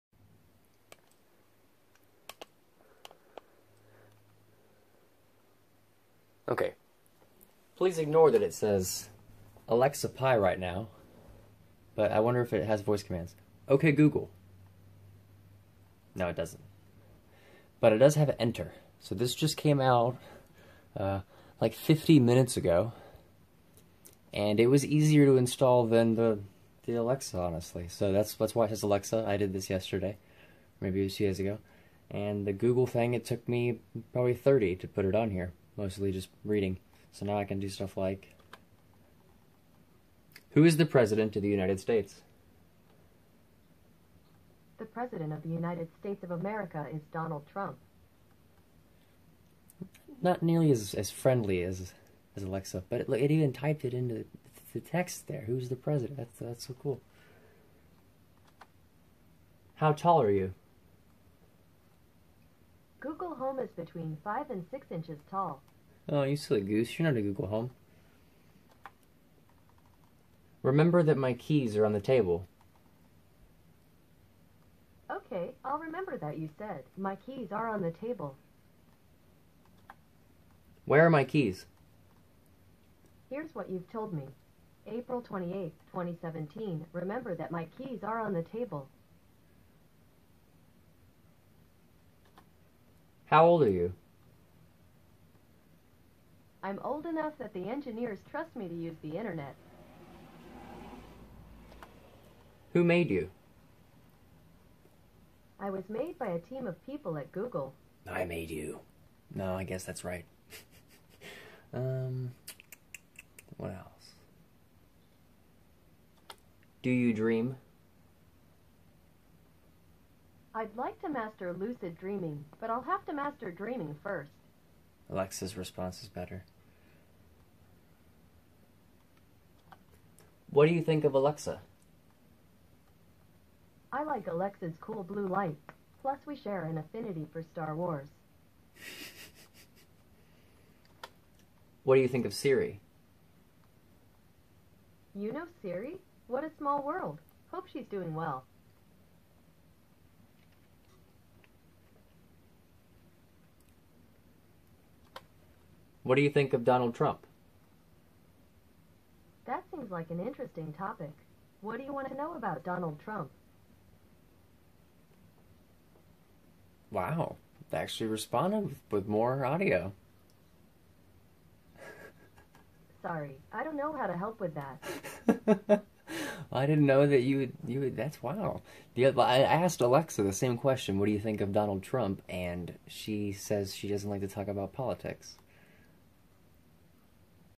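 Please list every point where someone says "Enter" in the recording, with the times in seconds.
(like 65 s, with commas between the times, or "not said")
18 s.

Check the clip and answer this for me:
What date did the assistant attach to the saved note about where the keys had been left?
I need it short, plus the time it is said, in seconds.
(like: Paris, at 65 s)
April 28, 2017, at 84 s.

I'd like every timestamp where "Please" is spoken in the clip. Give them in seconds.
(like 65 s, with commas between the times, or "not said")
7 s.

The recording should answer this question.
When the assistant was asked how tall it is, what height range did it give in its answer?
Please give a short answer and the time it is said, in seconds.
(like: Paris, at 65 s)
Between 5 and 6 inches, at 63 s.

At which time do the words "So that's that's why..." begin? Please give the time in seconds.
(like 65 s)
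27 s.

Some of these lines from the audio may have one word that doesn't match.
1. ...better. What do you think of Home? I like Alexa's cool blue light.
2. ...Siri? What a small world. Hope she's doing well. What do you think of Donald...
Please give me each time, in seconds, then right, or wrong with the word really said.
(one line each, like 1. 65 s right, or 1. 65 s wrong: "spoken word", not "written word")
1. 126 s wrong: "Alexa", not "Home"
2. 145 s right.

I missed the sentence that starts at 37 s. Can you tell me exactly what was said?
So now I can do stuff like Who is the President of the United States?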